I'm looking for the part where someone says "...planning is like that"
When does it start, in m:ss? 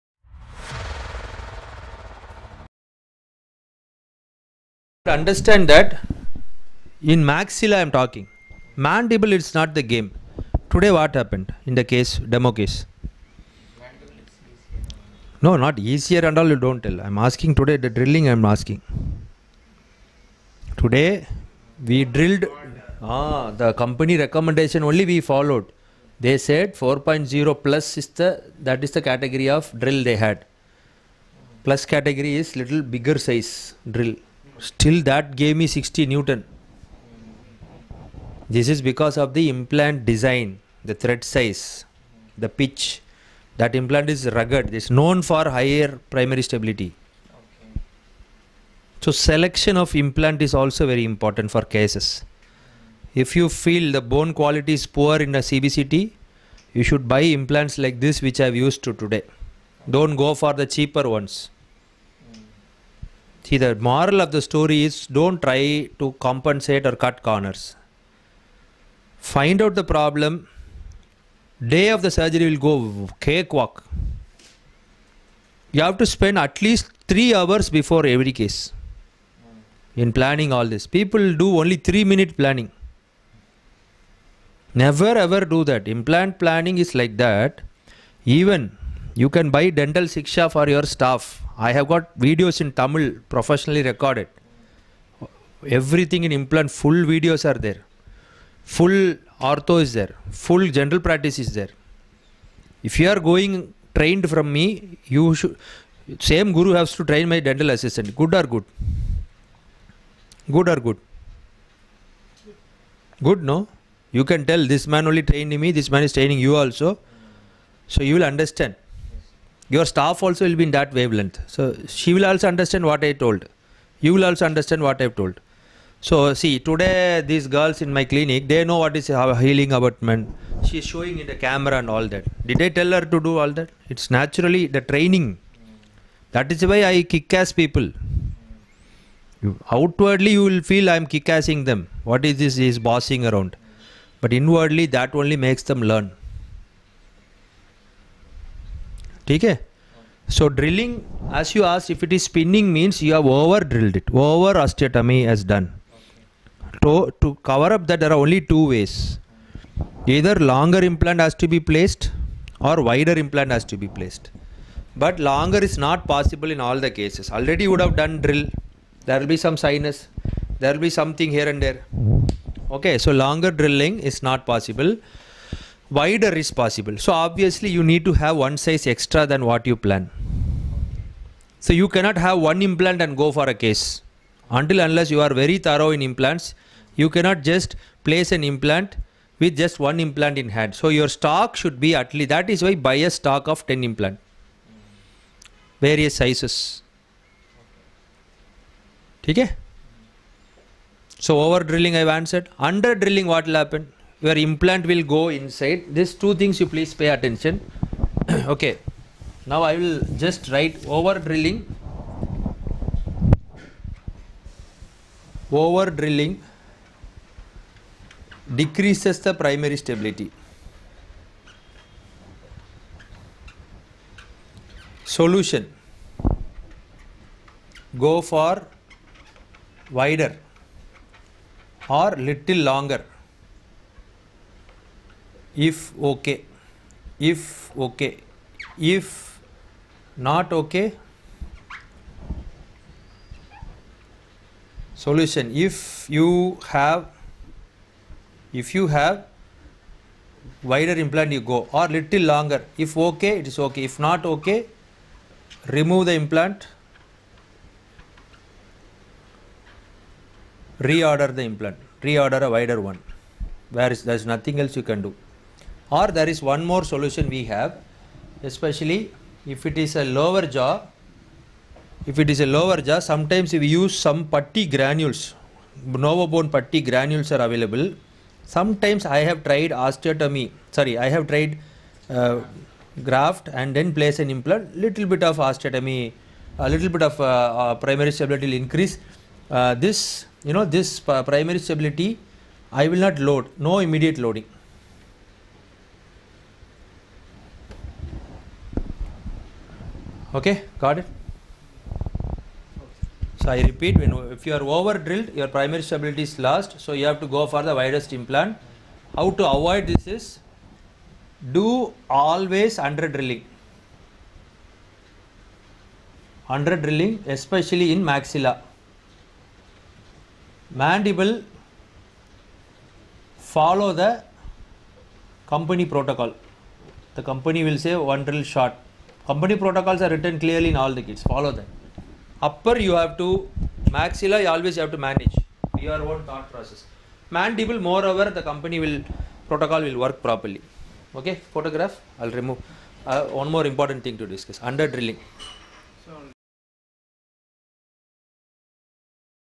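1:26.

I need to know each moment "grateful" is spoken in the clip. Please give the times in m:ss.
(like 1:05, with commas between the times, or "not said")
not said.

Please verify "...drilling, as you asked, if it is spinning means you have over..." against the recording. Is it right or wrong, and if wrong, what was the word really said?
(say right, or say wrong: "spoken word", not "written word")
right.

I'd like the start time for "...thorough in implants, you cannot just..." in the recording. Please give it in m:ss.
3:05.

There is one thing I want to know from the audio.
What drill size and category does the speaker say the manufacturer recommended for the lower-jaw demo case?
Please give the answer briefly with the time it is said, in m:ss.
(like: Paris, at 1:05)
4.0 plus, at 0:26.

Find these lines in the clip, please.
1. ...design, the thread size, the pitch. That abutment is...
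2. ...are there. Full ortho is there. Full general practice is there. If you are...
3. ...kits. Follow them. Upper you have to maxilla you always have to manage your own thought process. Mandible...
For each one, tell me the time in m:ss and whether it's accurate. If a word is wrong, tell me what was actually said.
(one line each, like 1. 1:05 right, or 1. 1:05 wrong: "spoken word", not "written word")
1. 0:40 wrong: "implant", not "abutment"
2. 1:37 right
3. 5:31 right.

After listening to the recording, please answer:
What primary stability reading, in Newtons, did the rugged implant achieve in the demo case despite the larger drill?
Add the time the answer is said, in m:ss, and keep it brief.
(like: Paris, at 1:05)
60 Newton, at 0:35.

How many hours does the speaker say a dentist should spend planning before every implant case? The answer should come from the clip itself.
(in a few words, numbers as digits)
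3 hours.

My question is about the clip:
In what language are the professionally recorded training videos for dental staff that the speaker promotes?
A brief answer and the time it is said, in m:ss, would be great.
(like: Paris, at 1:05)
Tamil, at 1:32.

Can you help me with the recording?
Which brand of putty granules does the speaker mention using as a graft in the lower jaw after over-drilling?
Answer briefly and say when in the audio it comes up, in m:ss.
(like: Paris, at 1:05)
NovaBone, at 4:35.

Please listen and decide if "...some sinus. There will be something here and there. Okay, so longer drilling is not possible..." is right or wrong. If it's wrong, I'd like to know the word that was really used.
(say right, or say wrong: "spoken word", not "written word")
right.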